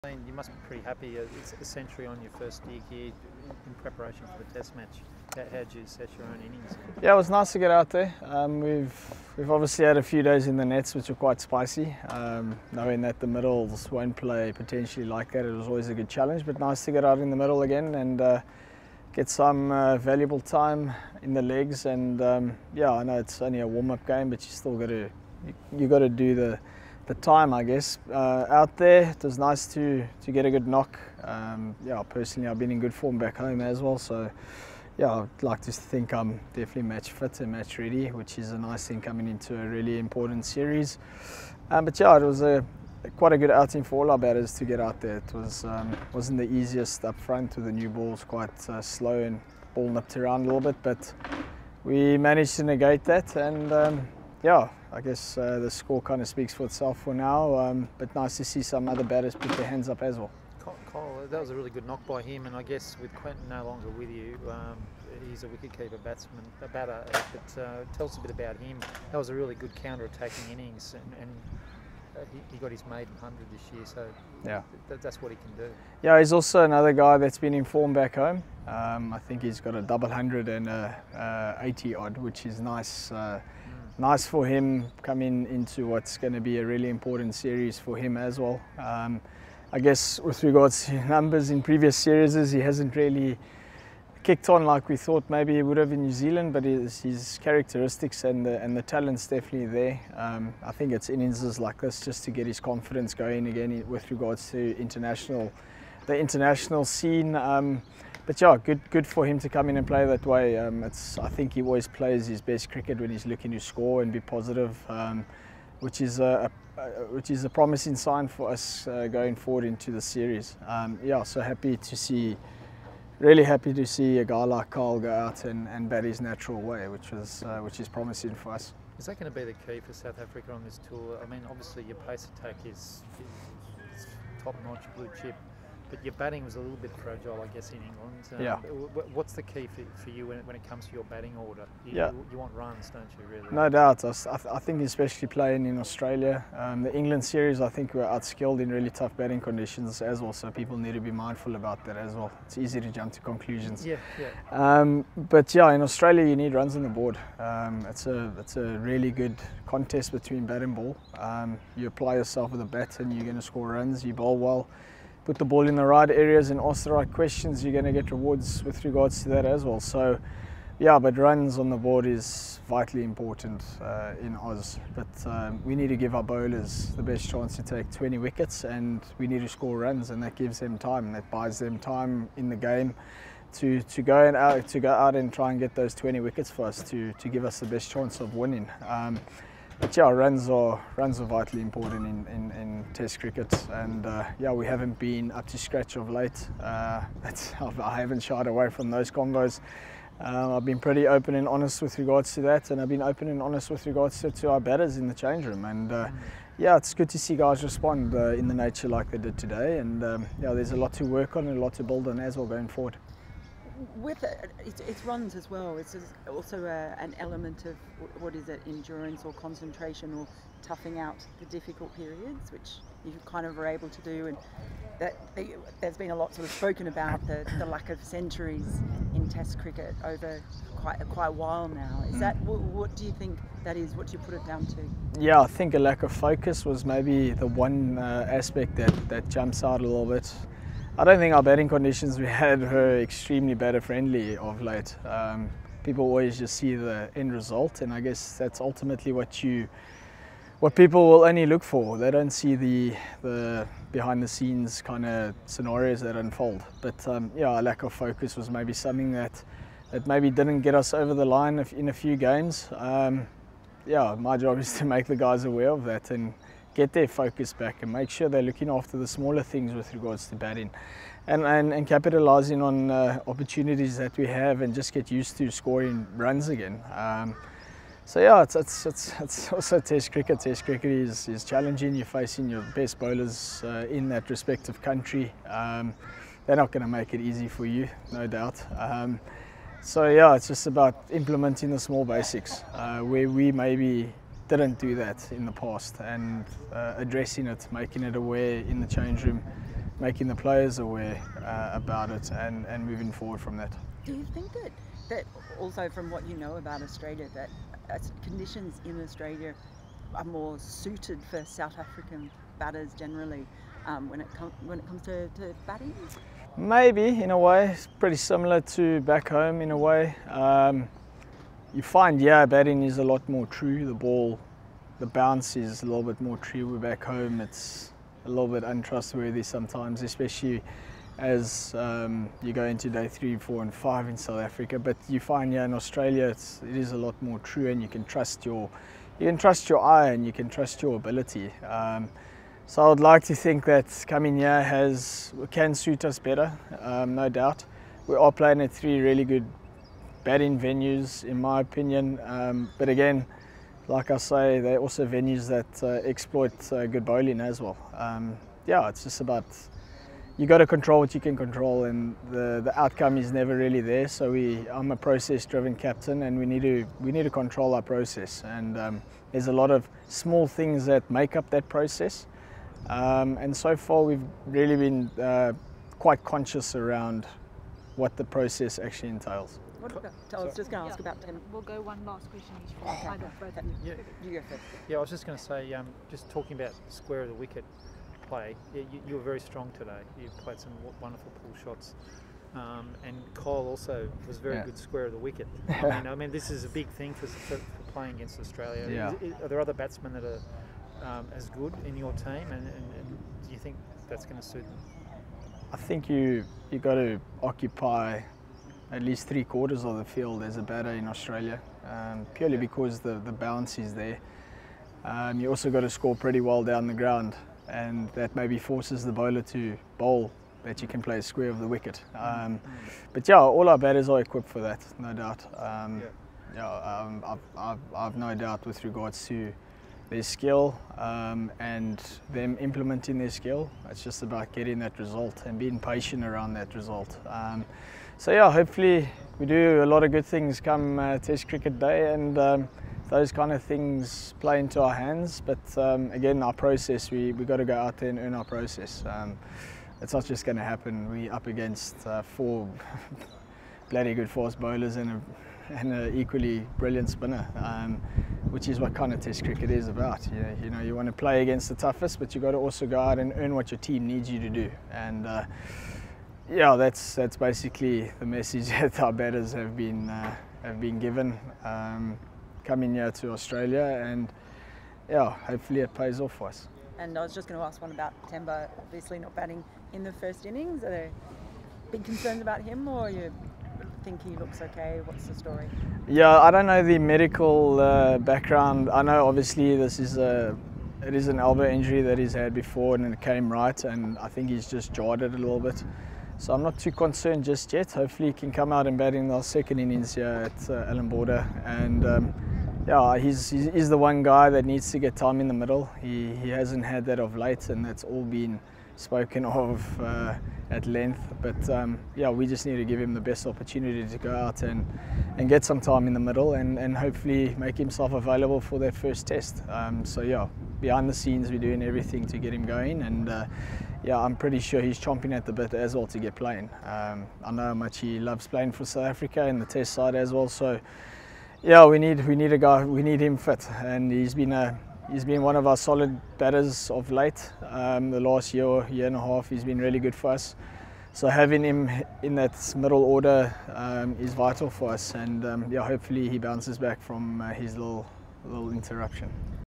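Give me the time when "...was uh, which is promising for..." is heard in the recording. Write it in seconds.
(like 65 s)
127 s.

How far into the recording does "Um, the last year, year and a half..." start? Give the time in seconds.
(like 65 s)
537 s.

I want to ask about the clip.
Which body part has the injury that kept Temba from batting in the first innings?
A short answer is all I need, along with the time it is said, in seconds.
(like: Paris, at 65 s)
Elbow, at 491 s.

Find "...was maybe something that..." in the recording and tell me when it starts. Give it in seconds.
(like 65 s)
258 s.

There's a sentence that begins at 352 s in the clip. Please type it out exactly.
Um, but again, like I say, they're also venues that uh, exploit uh, good bowling as well.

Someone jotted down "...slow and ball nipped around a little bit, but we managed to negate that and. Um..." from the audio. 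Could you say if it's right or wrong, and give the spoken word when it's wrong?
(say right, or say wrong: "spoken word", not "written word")
right.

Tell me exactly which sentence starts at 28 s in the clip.
Uh, out there, it was nice to to get a good knock.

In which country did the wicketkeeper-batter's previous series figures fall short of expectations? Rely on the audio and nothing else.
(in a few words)
New Zealand.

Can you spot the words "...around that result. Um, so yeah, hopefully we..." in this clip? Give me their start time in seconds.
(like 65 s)
436 s.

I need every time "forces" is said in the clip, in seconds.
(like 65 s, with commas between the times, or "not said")
418 s, 454 s.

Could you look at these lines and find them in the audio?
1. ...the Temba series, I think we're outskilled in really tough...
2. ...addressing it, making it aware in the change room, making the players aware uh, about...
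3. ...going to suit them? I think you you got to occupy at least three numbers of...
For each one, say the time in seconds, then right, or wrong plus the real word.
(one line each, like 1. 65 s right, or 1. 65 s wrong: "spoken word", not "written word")
1. 146 s wrong: "England", not "Temba"
2. 296 s right
3. 404 s wrong: "quarters", not "numbers".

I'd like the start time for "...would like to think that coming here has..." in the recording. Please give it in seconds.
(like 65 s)
342 s.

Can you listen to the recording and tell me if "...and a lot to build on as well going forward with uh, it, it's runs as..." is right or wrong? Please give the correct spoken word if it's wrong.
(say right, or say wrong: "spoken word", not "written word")
right.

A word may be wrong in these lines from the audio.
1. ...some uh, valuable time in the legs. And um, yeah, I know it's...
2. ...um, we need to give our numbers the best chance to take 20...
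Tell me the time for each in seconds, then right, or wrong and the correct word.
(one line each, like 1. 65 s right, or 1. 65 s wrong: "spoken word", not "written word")
1. 19 s right
2. 175 s wrong: "bowlers", not "numbers".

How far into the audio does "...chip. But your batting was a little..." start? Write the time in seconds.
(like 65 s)
135 s.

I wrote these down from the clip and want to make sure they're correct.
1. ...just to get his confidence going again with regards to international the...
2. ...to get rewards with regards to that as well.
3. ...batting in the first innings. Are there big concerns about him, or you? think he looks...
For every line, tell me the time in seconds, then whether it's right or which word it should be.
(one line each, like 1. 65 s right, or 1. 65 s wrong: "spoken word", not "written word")
1. 102 s right
2. 167 s right
3. 479 s right.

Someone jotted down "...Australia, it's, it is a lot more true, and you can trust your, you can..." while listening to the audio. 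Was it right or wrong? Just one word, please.
right.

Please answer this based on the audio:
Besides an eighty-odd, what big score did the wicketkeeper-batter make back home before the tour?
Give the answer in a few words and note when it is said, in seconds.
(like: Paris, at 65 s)
A double hundred, at 79 s.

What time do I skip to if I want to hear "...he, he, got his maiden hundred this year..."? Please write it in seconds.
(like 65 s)
72 s.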